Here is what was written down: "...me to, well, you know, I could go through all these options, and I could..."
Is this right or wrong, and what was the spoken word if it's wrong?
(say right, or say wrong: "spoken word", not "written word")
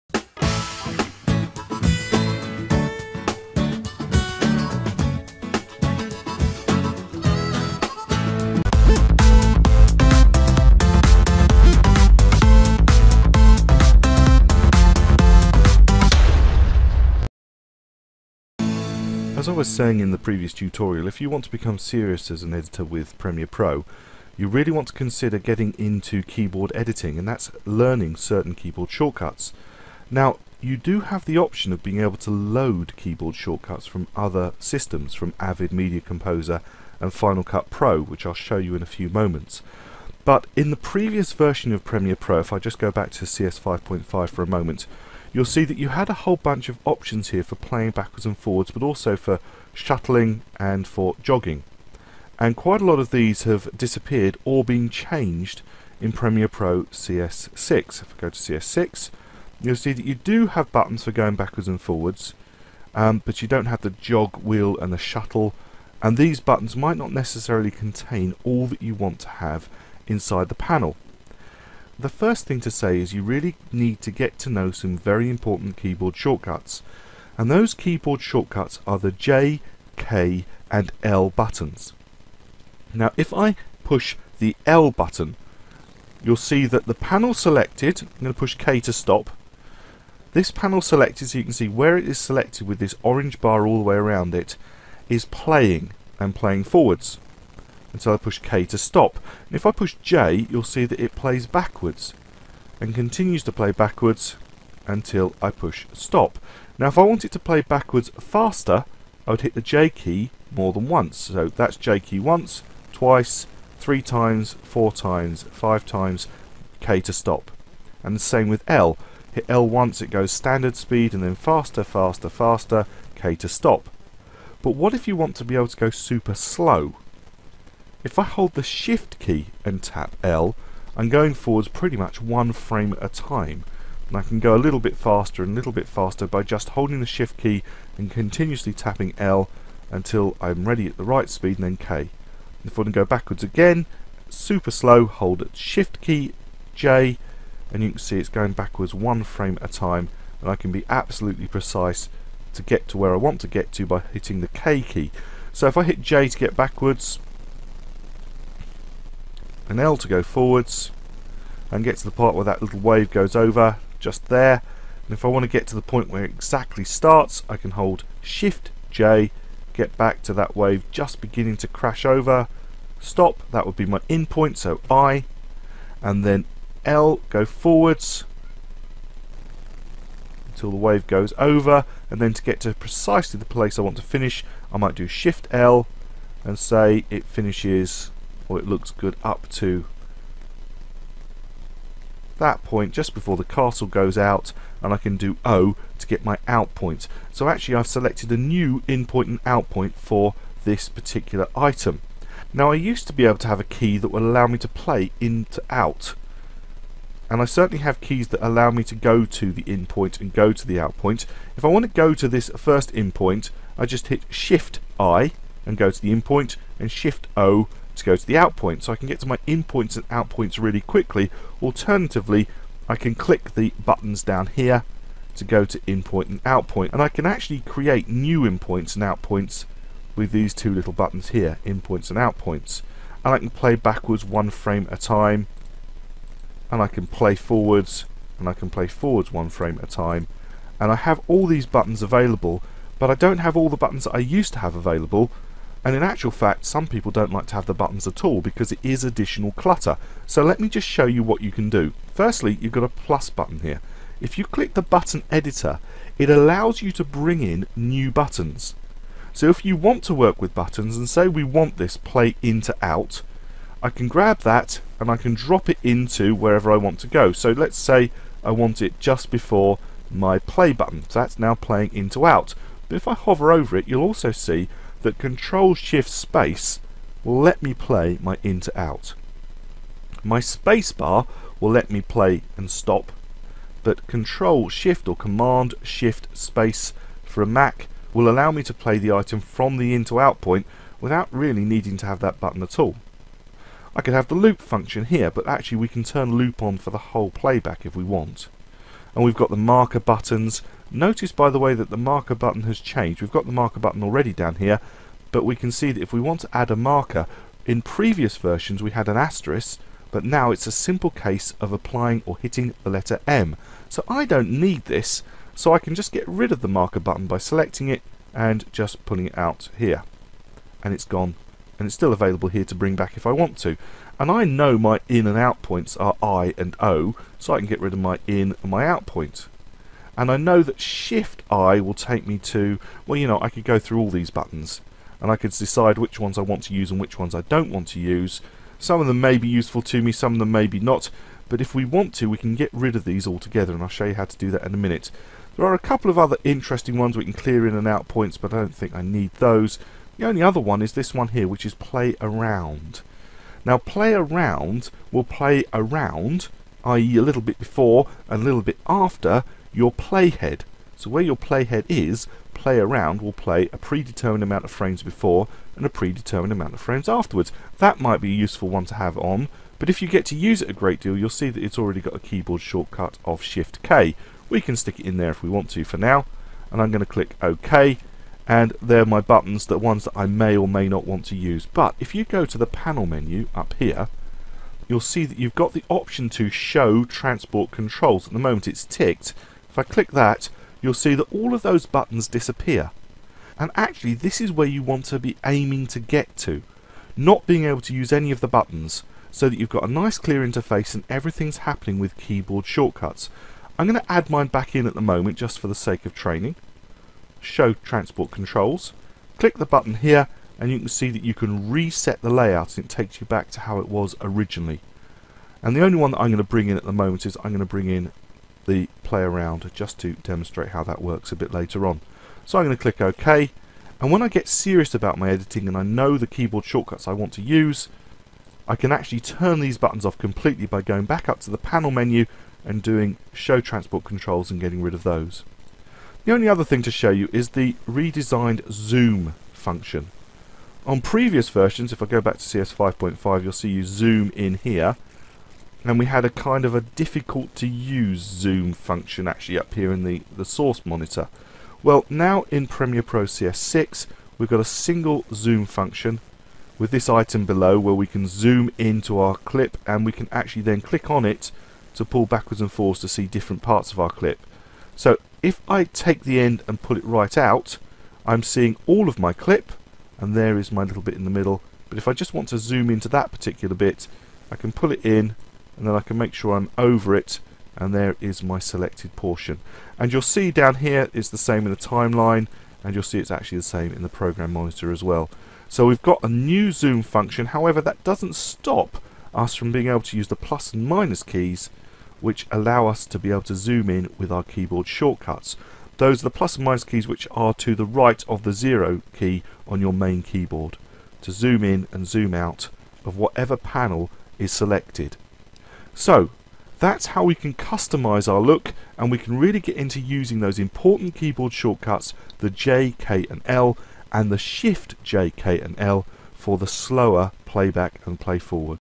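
wrong: "buttons", not "options".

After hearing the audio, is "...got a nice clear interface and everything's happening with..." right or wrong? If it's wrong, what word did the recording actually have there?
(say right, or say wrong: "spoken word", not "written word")
right.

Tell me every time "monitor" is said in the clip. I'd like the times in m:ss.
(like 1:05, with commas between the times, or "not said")
7:30, 8:04.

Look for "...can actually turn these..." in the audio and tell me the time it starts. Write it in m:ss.
7:08.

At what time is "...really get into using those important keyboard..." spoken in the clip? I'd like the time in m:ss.
8:29.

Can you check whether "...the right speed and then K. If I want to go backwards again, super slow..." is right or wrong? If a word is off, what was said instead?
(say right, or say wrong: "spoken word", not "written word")
right.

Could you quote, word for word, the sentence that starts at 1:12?
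The first thing to say is you really need to get to know some very important keyboard shortcuts.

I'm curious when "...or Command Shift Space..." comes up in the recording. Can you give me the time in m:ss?
4:45.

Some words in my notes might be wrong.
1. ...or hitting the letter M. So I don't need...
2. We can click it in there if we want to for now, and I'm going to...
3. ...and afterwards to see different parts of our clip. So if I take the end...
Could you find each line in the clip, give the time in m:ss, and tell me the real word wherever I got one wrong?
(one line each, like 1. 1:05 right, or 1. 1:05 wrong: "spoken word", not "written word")
1. 5:12 right
2. 6:14 wrong: "stick", not "click"
3. 7:42 wrong: "forwards", not "afterwards".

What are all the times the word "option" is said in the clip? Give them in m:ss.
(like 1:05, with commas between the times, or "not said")
0:31, 0:46, 6:25.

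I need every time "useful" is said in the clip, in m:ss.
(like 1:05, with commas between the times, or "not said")
5:39, 6:08.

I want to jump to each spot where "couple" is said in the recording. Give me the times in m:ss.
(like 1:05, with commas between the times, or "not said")
5:45.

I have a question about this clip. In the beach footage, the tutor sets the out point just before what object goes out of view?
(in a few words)
The castle.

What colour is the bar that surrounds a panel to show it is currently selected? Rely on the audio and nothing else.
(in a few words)
Orange.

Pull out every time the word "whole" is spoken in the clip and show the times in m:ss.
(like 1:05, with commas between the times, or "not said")
0:46, 4:57.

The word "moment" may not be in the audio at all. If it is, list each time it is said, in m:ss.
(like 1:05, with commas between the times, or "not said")
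0:39, 0:44, 6:28, 6:45, 6:56.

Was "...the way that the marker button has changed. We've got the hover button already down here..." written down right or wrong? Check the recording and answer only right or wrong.
wrong.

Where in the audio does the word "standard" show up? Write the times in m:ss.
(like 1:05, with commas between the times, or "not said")
2:00.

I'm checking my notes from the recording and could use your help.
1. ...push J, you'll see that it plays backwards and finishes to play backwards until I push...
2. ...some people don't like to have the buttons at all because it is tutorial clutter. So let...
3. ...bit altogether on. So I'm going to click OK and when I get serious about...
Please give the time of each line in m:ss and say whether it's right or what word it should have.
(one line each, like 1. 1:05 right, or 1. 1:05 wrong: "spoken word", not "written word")
1. 1:39 wrong: "continues", not "finishes"
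2. 4:06 wrong: "additional", not "tutorial"
3. 7:01 wrong: "later", not "altogether".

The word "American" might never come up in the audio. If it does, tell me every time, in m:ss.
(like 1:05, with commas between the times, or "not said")
not said.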